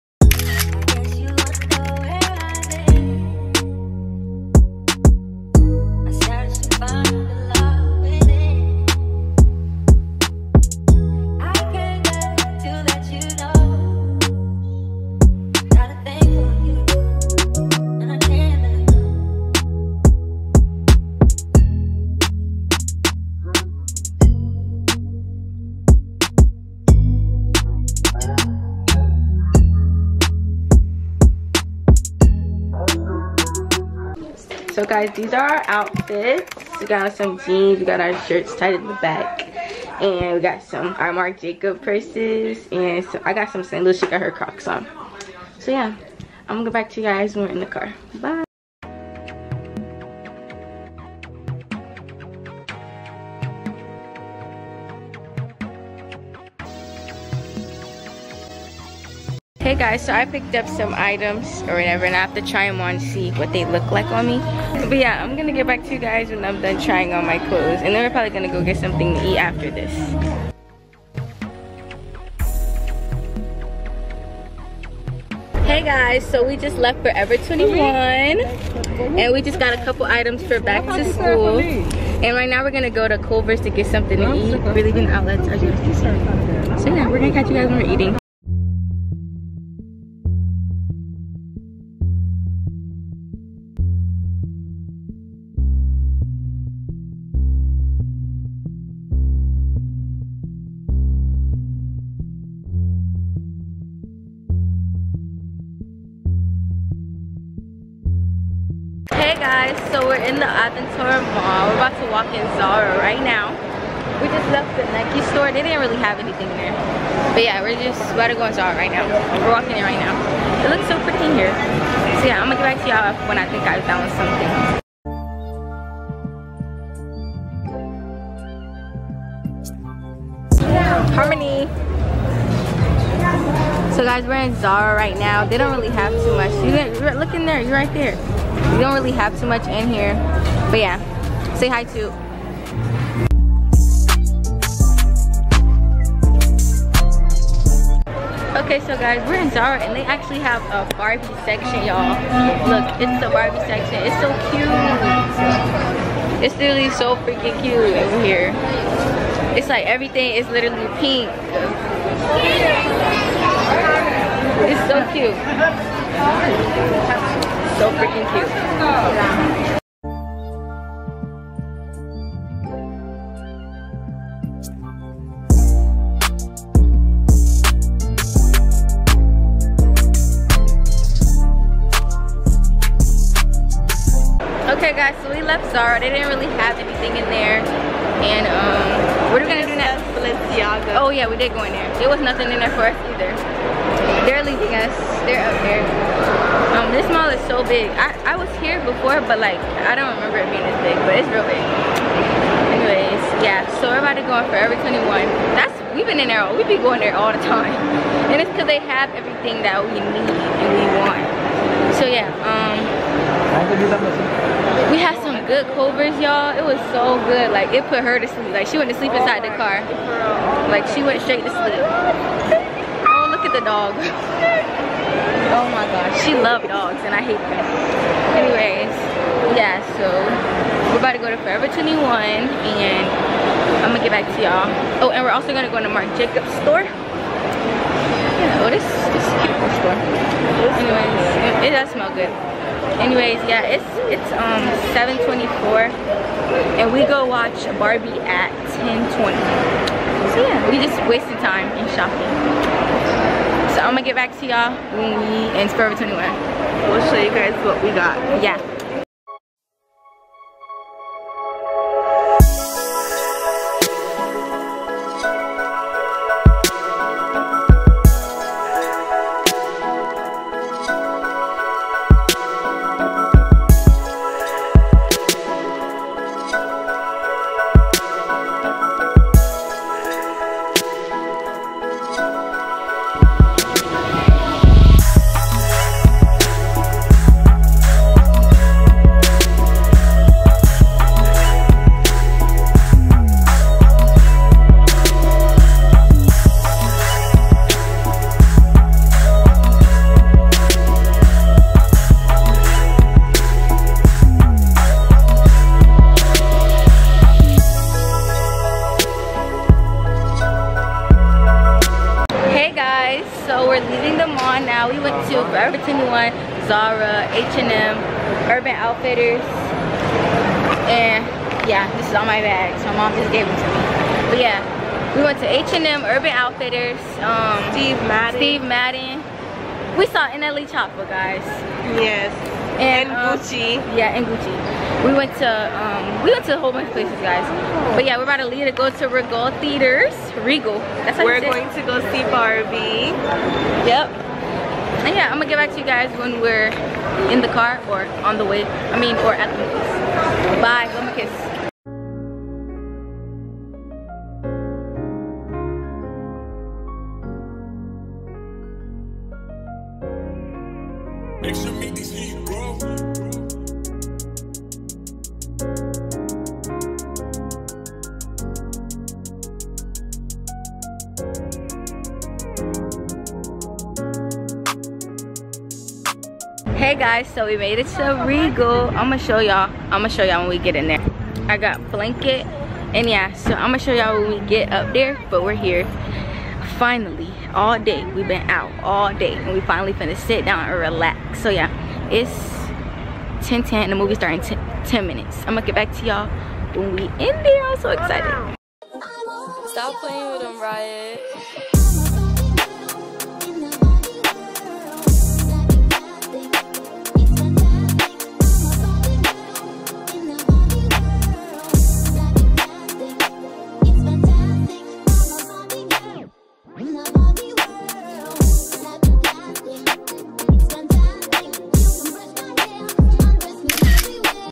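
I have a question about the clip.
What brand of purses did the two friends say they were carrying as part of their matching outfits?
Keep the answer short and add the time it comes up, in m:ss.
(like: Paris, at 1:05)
Marc Jacobs, at 0:41.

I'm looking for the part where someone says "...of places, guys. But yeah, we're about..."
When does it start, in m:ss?
5:36.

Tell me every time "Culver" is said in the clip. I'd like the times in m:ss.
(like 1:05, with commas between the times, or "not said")
1:23, 3:35.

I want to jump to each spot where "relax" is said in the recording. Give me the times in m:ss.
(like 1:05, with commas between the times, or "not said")
6:30.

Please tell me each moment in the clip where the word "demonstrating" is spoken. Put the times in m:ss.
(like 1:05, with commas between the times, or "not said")
not said.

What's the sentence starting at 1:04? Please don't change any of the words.
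But yeah, I'm gonna get back to you guys when I'm done trying on my clothes.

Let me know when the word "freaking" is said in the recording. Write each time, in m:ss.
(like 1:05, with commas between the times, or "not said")
2:37, 2:47.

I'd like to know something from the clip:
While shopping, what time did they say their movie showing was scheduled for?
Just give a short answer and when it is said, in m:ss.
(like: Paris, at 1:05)
10:20, at 4:08.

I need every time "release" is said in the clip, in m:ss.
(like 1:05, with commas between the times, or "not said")
not said.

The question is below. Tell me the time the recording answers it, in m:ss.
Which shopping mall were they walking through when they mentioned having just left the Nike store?
1:50.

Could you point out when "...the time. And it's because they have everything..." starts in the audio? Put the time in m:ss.
3:27.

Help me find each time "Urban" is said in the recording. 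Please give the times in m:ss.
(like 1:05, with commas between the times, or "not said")
5:18, 5:26.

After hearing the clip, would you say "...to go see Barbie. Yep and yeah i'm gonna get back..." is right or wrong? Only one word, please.
right.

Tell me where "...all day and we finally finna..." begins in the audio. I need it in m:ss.
6:28.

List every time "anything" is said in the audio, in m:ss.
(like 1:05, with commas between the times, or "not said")
1:56, 3:06.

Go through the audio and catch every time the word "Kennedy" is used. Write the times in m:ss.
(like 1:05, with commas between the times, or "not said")
not said.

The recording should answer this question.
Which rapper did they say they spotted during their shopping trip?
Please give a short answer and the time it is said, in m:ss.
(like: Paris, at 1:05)
NLE Choppa, at 5:30.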